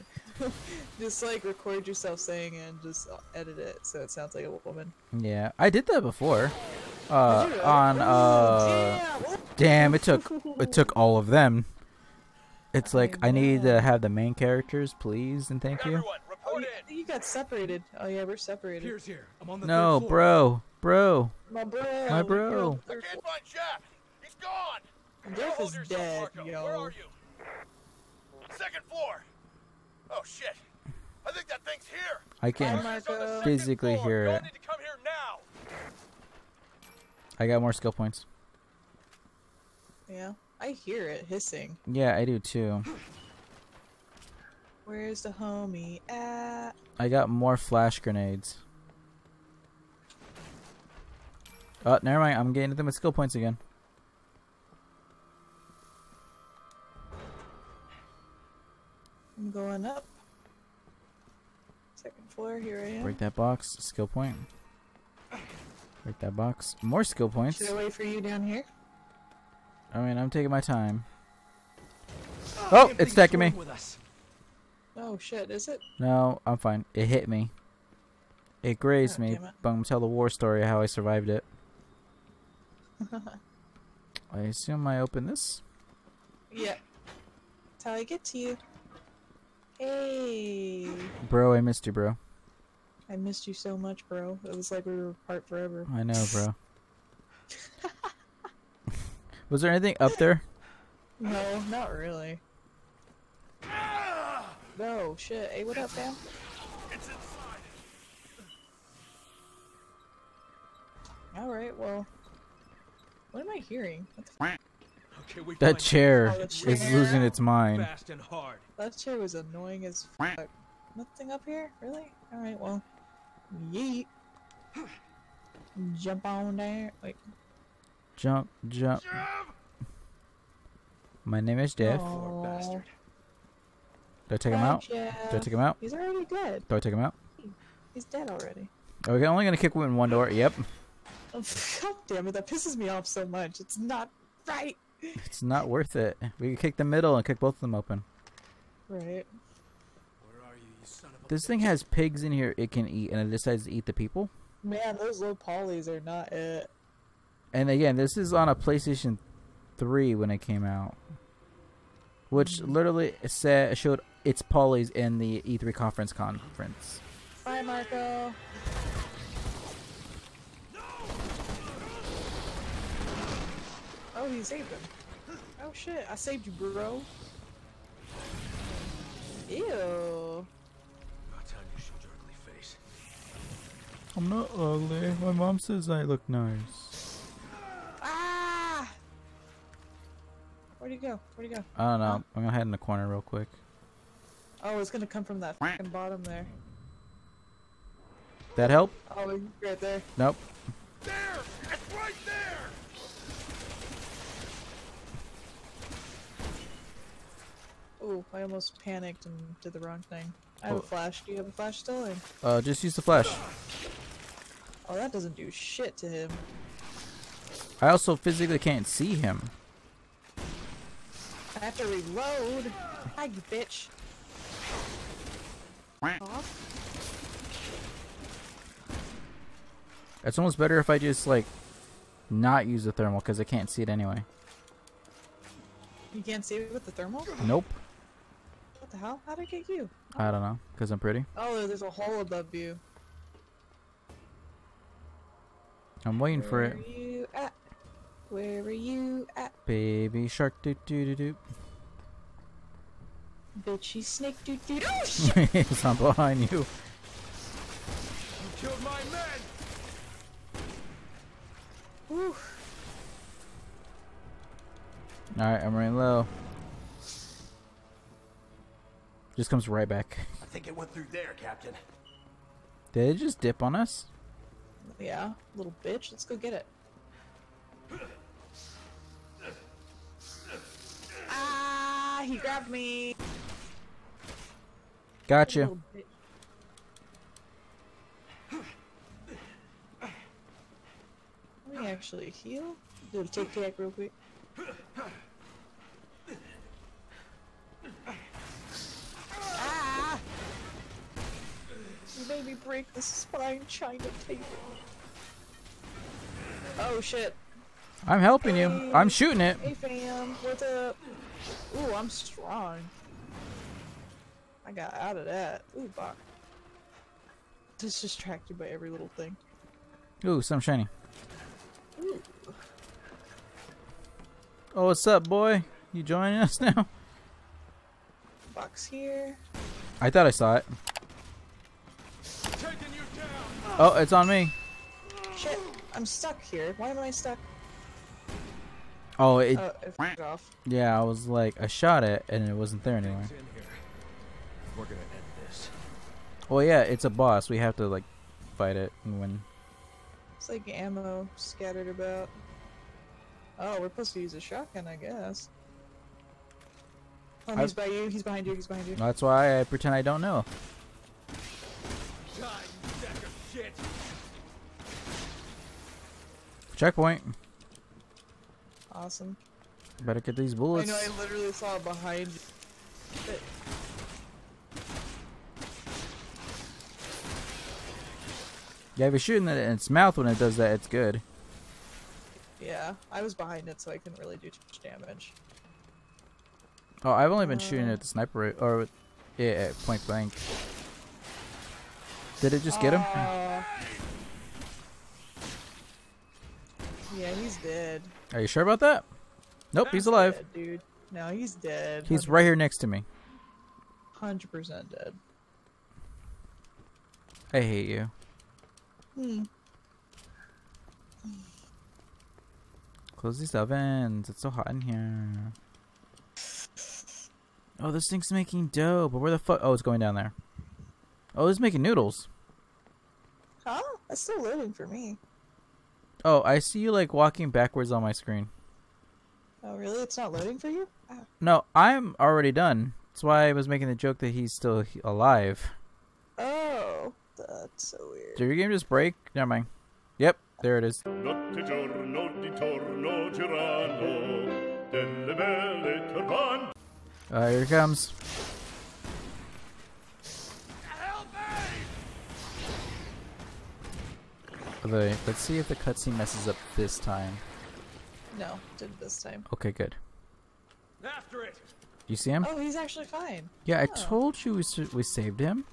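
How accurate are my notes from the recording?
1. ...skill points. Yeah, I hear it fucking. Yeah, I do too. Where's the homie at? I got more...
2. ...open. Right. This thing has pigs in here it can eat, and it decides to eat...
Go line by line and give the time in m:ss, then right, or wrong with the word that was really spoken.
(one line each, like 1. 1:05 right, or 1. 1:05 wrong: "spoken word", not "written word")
1. 0:37 wrong: "hissing", not "fucking"
2. 2:27 right.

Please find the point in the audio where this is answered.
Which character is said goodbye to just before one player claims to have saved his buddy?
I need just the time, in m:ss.
2:47.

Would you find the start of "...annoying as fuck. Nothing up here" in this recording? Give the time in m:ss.
1:59.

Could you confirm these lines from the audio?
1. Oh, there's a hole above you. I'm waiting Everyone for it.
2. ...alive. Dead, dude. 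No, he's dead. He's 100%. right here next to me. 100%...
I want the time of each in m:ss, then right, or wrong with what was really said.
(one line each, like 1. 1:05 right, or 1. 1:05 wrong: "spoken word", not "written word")
1. 4:01 wrong: "Where", not "Everyone"
2. 6:40 right.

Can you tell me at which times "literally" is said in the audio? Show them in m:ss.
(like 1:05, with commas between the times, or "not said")
2:42, 6:11.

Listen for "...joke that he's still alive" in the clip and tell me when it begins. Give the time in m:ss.
7:13.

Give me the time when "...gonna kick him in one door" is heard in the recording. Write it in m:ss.
2:19.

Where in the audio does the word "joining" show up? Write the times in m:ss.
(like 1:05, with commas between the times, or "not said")
5:26.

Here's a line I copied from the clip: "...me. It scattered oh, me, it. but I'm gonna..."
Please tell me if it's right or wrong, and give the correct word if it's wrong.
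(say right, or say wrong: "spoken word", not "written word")
wrong: "grazed", not "scattered".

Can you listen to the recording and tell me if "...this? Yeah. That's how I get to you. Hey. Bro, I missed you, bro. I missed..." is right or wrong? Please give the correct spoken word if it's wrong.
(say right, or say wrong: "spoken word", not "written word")
right.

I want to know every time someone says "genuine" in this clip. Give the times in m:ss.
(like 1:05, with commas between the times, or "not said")
not said.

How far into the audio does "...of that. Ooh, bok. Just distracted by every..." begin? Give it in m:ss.
5:15.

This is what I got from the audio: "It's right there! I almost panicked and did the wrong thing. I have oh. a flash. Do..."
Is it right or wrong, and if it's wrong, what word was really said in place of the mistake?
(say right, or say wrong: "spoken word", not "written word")
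right.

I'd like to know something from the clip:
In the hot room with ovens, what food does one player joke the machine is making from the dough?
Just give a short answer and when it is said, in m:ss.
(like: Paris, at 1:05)
noodles, at 7:01.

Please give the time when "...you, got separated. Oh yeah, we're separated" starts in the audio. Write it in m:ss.
0:16.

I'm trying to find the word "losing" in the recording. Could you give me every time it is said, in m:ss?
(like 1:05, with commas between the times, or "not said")
1:56.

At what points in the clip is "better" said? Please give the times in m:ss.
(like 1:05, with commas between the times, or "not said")
3:50, 6:10.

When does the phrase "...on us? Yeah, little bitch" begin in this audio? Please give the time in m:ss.
4:33.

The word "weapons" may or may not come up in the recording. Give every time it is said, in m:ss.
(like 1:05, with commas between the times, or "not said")
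not said.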